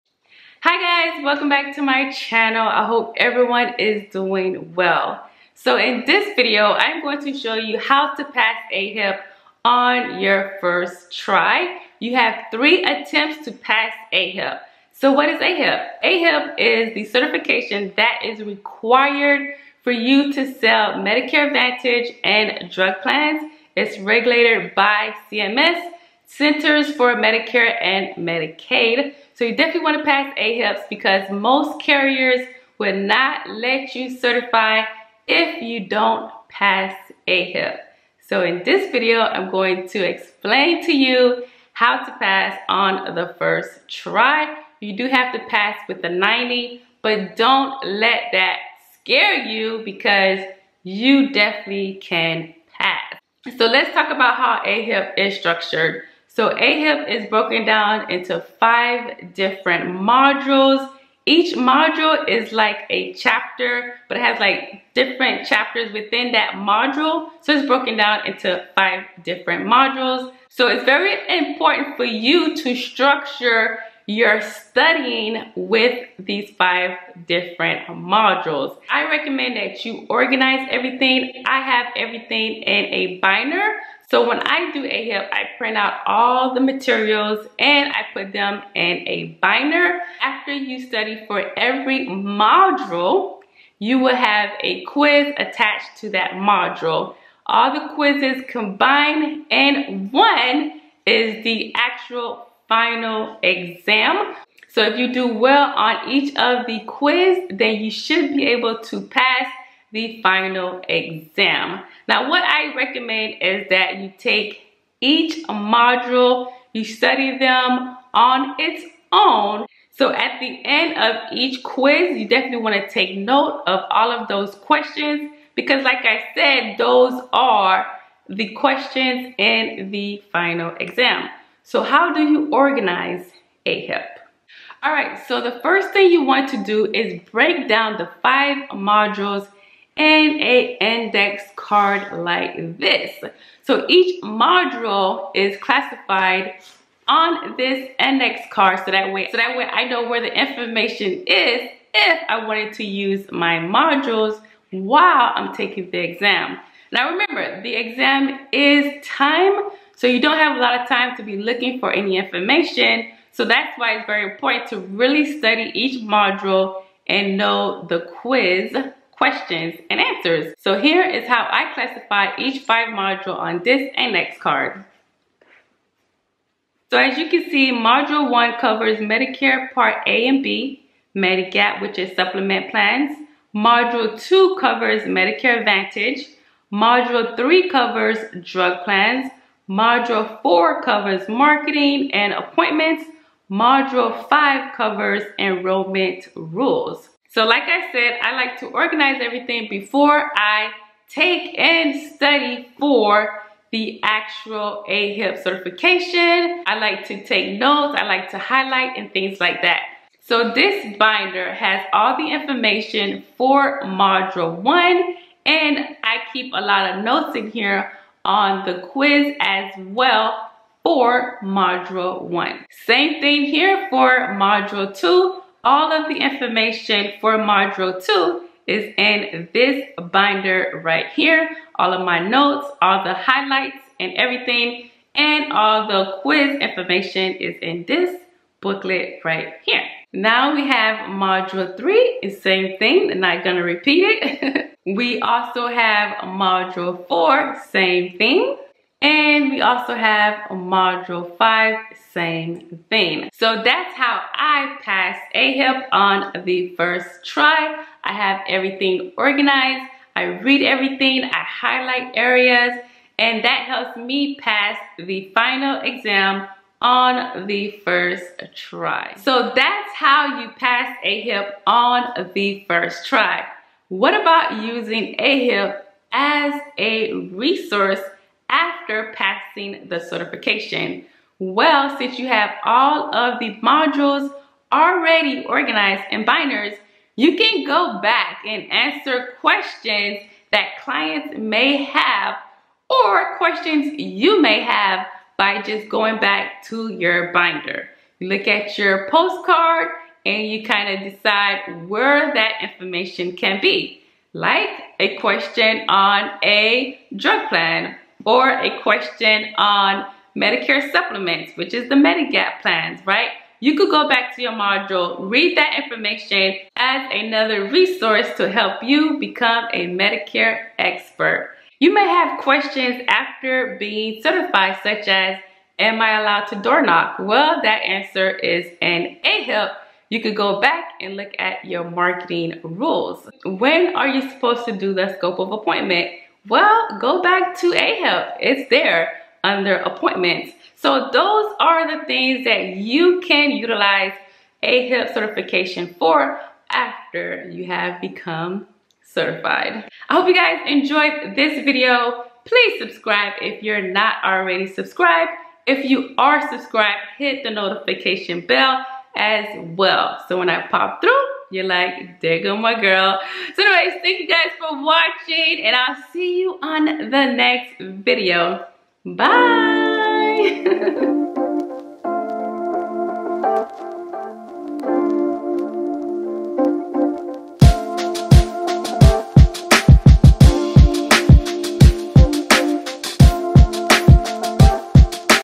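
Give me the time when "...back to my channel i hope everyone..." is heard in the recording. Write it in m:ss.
0:01.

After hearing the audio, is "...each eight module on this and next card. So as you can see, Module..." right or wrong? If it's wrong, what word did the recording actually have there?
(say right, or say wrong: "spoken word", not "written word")
wrong: "five", not "eight".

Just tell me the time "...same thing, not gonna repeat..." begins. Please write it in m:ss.
4:02.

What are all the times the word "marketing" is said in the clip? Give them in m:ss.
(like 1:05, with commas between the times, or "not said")
3:11, 5:31.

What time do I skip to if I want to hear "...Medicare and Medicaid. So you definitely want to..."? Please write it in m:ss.
0:27.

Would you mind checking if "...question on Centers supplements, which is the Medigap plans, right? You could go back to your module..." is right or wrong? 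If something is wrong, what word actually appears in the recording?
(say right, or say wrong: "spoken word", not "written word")
wrong: "Medicare", not "Centers".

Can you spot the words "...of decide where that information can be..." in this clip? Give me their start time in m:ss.
5:01.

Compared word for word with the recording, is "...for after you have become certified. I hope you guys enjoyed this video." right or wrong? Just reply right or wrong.
right.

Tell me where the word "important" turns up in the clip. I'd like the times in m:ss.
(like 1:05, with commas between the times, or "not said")
1:11, 2:44.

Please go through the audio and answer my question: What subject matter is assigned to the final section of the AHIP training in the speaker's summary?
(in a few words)
Enrollment rules.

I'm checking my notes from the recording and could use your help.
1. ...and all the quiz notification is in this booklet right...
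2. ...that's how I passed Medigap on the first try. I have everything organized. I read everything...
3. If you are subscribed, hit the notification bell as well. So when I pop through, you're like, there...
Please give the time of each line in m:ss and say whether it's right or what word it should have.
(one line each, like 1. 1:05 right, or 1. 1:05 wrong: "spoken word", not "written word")
1. 3:55 wrong: "information", not "notification"
2. 4:13 wrong: "AHIP", not "Medigap"
3. 5:55 right.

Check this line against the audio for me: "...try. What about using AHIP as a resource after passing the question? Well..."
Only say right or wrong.
wrong.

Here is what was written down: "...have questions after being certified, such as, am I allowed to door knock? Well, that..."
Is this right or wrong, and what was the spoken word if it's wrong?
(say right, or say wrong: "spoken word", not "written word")
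right.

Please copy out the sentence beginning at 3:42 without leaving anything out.
Same thing here for module two all of the information for Module 2 is in this binder right here.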